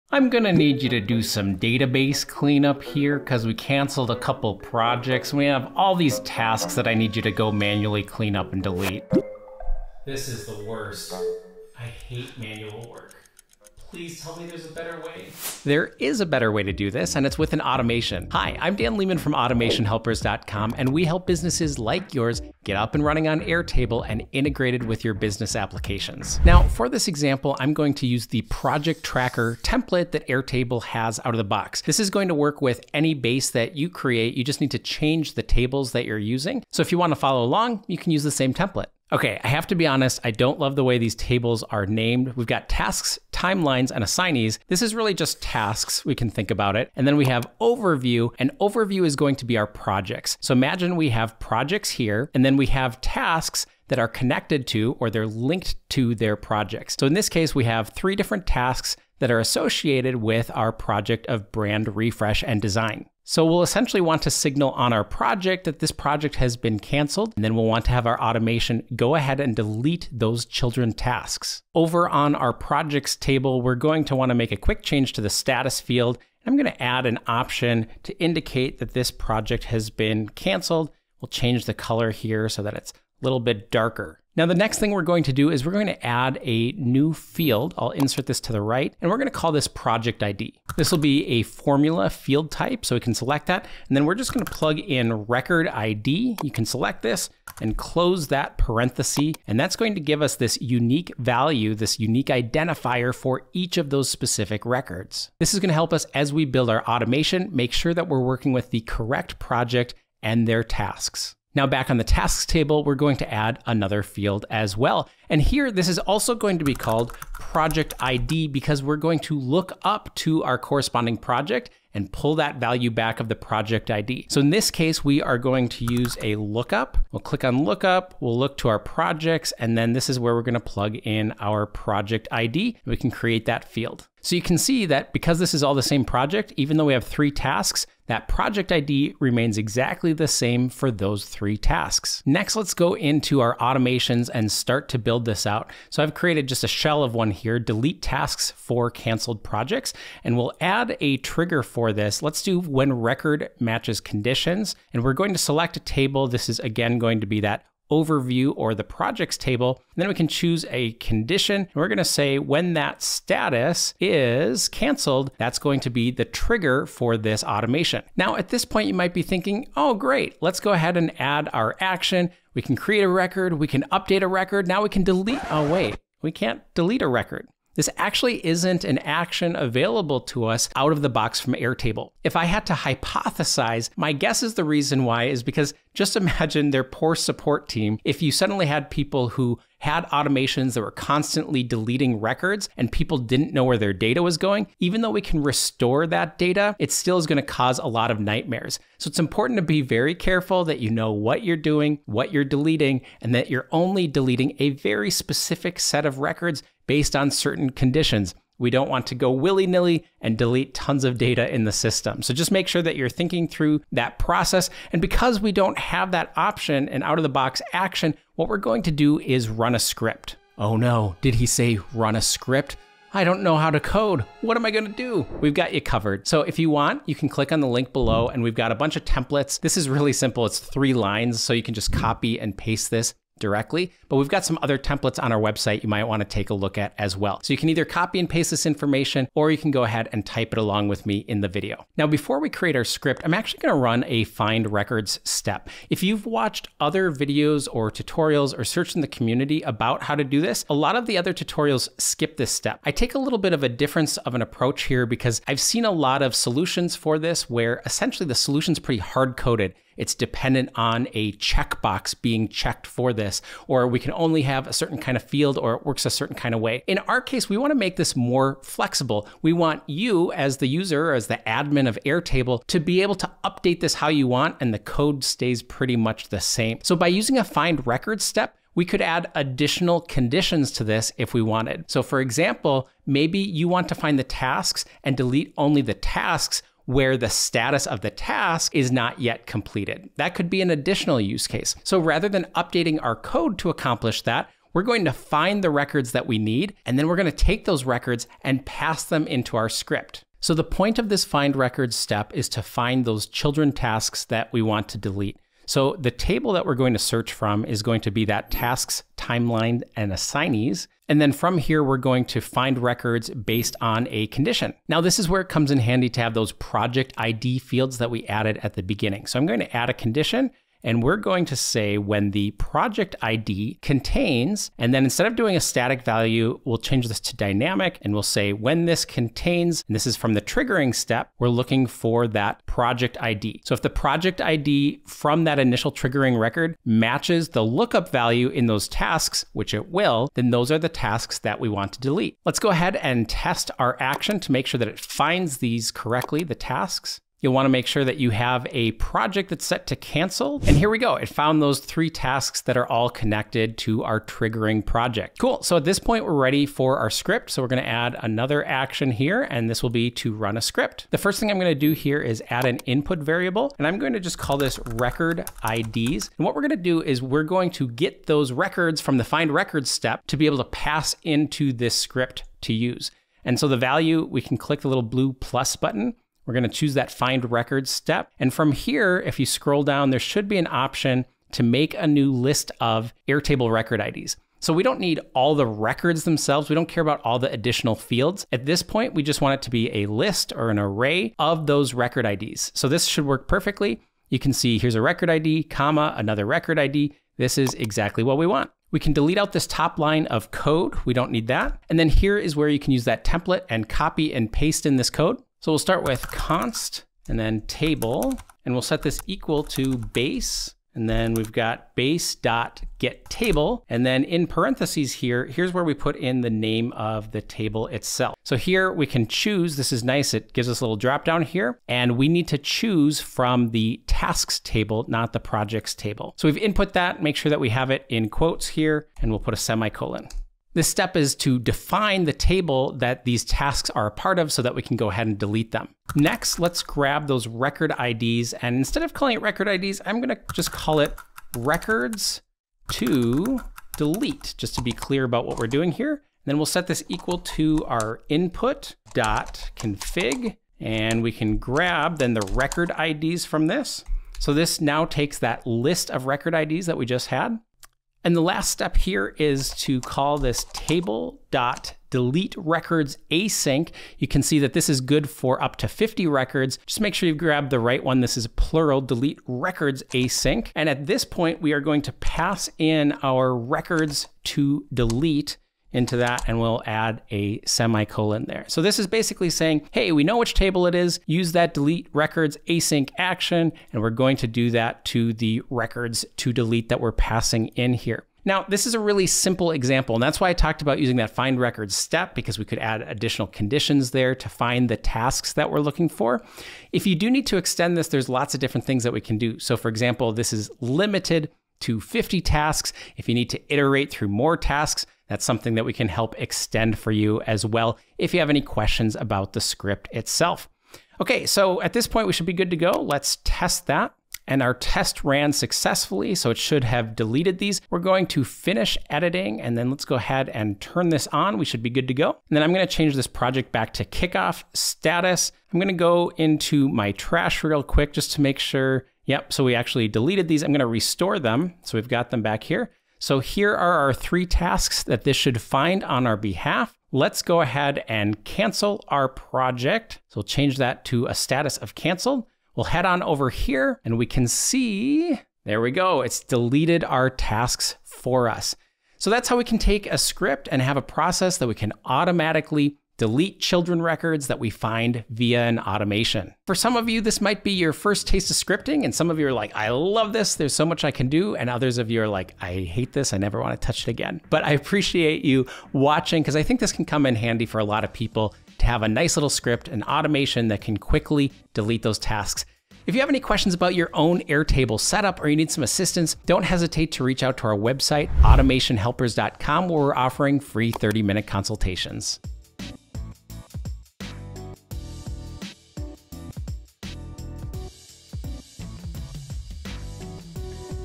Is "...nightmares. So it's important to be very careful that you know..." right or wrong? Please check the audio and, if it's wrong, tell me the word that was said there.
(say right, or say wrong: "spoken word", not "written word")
right.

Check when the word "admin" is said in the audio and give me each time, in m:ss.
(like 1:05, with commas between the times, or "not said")
4:31.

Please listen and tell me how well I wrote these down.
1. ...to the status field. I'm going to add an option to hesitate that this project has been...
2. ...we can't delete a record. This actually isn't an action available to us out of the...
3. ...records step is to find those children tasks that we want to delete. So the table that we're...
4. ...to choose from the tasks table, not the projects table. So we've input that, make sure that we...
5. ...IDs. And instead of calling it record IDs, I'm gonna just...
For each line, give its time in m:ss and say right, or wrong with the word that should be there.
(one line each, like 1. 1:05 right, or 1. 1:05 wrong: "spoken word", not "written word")
1. 1:15 wrong: "indicate", not "hesitate"
2. 2:56 right
3. 5:01 right
4. 7:02 right
5. 7:17 right.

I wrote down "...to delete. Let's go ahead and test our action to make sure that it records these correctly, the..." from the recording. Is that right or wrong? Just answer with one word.
wrong.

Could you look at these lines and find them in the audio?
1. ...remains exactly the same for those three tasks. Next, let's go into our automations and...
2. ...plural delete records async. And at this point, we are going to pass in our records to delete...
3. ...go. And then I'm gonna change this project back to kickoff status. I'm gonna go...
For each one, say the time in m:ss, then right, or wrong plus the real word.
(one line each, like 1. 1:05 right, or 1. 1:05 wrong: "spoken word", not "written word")
1. 2:19 right
2. 7:48 right
3. 8:42 right.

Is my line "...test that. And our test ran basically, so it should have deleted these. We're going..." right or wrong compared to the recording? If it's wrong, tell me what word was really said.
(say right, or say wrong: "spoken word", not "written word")
wrong: "successfully", not "basically".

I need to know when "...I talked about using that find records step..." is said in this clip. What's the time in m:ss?
8:10.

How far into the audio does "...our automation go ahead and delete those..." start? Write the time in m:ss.
1:08.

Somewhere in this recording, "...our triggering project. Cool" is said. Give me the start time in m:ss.
5:54.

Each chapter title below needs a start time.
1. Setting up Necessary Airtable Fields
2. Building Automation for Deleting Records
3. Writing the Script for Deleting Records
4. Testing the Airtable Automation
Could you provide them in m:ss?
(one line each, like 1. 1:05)
1. 1:11
2. 2:22
3. 5:55
4. 8:31.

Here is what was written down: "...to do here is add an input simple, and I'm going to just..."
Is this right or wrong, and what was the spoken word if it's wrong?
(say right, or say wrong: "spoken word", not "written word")
wrong: "variable", not "simple".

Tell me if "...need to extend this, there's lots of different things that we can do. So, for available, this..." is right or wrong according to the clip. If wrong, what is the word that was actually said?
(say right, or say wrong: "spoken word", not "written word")
wrong: "example", not "available".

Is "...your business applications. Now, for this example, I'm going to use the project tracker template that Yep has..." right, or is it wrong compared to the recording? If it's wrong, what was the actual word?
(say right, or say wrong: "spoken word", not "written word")
wrong: "Airtable", not "Yep".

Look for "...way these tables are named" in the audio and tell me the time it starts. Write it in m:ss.
0:40.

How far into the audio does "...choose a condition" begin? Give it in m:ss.
2:40.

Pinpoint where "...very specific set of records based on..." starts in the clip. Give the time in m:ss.
3:24.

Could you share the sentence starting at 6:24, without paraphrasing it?
So we don't need all the records themselves.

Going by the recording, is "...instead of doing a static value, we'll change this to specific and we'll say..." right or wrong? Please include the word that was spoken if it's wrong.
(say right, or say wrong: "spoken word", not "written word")
wrong: "dynamic", not "specific".